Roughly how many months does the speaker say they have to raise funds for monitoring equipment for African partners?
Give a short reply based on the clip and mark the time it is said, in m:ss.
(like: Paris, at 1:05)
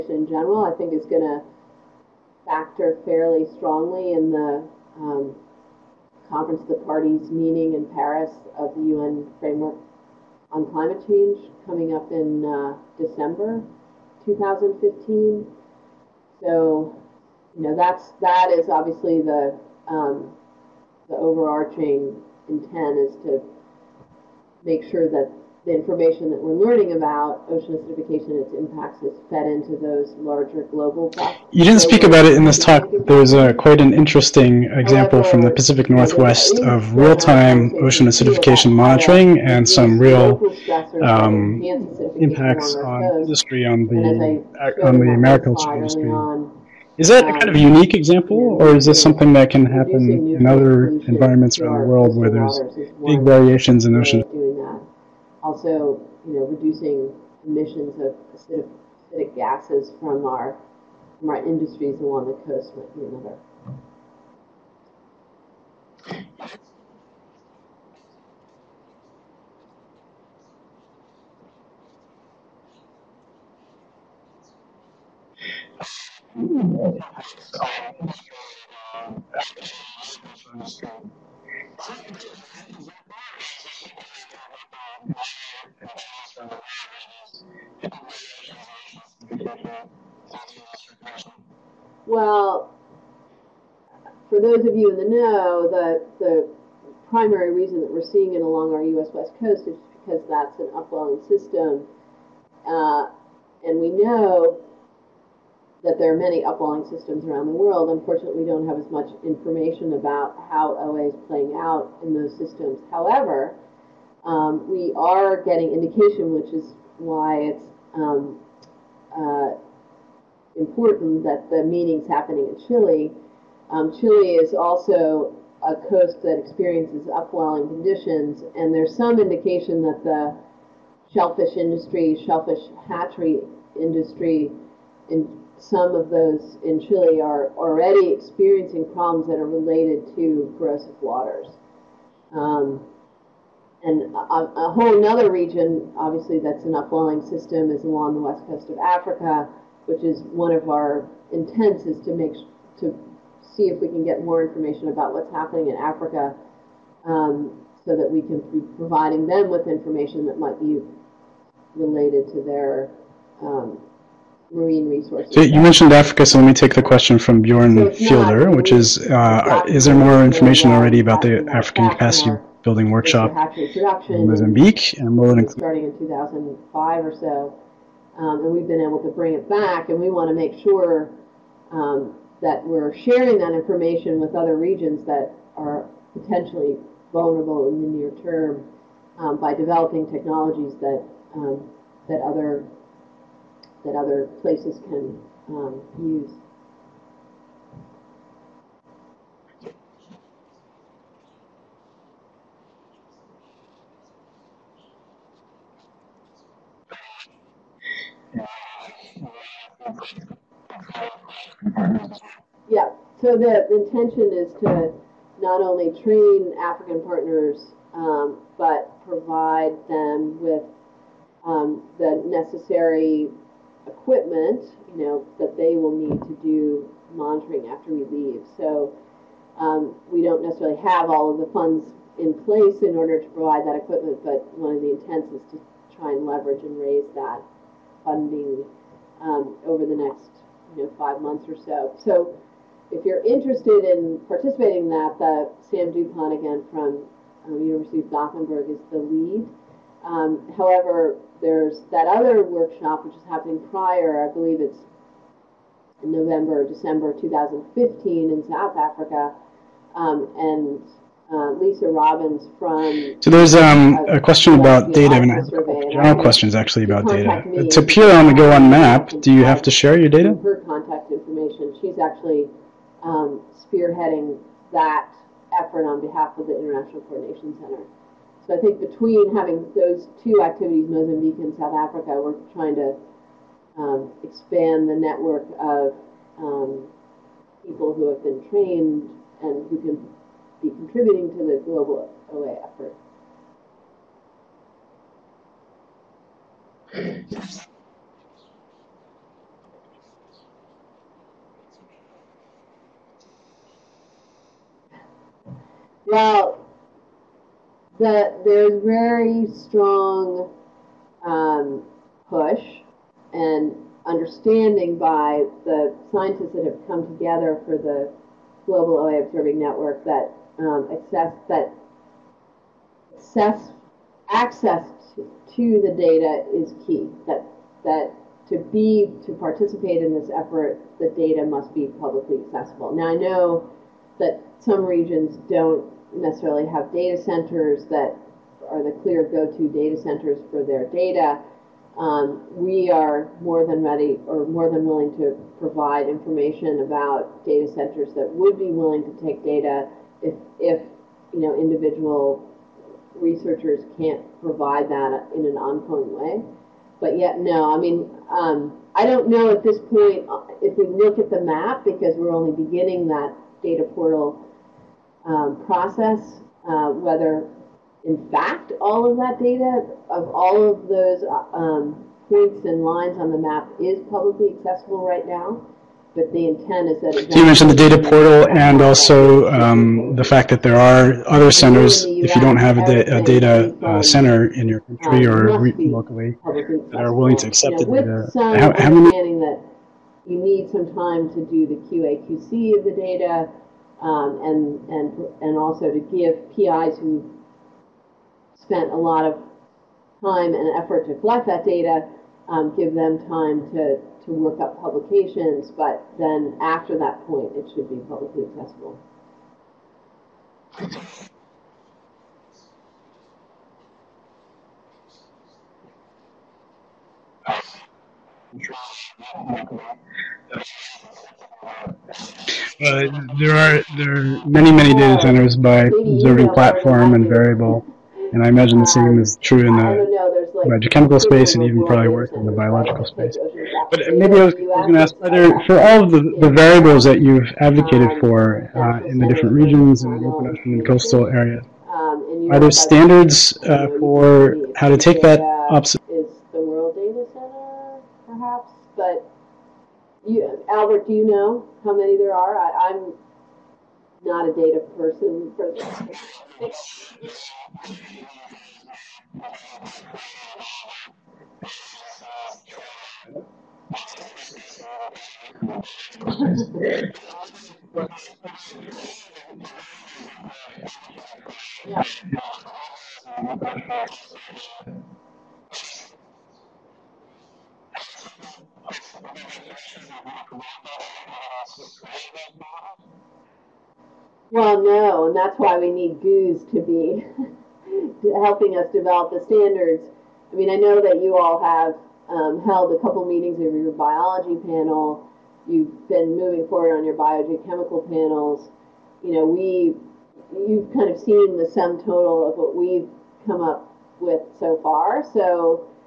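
5 months, at 4:00.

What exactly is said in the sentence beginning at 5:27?
That that to be to participate in this effort, the data must be publicly accessible.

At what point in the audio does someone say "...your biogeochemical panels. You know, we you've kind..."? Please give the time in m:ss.
8:17.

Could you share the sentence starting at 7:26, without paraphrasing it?
Is the world data center perhaps, but you, Albert, do you know how many there are?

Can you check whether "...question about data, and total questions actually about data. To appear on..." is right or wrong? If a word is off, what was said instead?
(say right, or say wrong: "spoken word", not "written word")
wrong: "general", not "total".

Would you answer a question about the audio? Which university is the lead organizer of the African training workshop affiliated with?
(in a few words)
University of Gothenburg.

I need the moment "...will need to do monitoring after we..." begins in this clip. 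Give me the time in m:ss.
3:45.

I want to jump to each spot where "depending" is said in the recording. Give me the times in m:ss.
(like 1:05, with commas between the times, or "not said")
not said.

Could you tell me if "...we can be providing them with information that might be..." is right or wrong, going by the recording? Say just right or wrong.
right.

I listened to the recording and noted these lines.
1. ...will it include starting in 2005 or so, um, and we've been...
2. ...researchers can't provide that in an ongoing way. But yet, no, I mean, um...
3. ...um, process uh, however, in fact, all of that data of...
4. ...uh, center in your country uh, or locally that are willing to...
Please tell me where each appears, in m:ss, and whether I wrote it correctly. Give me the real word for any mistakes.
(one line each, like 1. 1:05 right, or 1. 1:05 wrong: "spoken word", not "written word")
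1. 2:55 right
2. 5:53 right
3. 6:05 wrong: "whether", not "however"
4. 6:23 right.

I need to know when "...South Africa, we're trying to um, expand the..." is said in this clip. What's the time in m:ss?
4:41.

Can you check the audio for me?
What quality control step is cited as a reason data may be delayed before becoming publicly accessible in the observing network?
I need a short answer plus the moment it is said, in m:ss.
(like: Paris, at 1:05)
QA QC, at 6:31.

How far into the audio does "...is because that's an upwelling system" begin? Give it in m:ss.
1:39.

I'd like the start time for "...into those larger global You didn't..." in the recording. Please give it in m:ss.
0:29.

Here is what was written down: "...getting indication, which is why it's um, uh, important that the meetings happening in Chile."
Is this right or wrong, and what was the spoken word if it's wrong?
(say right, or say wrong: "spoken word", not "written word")
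right.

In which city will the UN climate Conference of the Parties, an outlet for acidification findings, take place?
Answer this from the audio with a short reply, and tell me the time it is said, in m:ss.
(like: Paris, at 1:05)
Paris, at 0:07.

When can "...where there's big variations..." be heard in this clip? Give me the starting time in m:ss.
0:52.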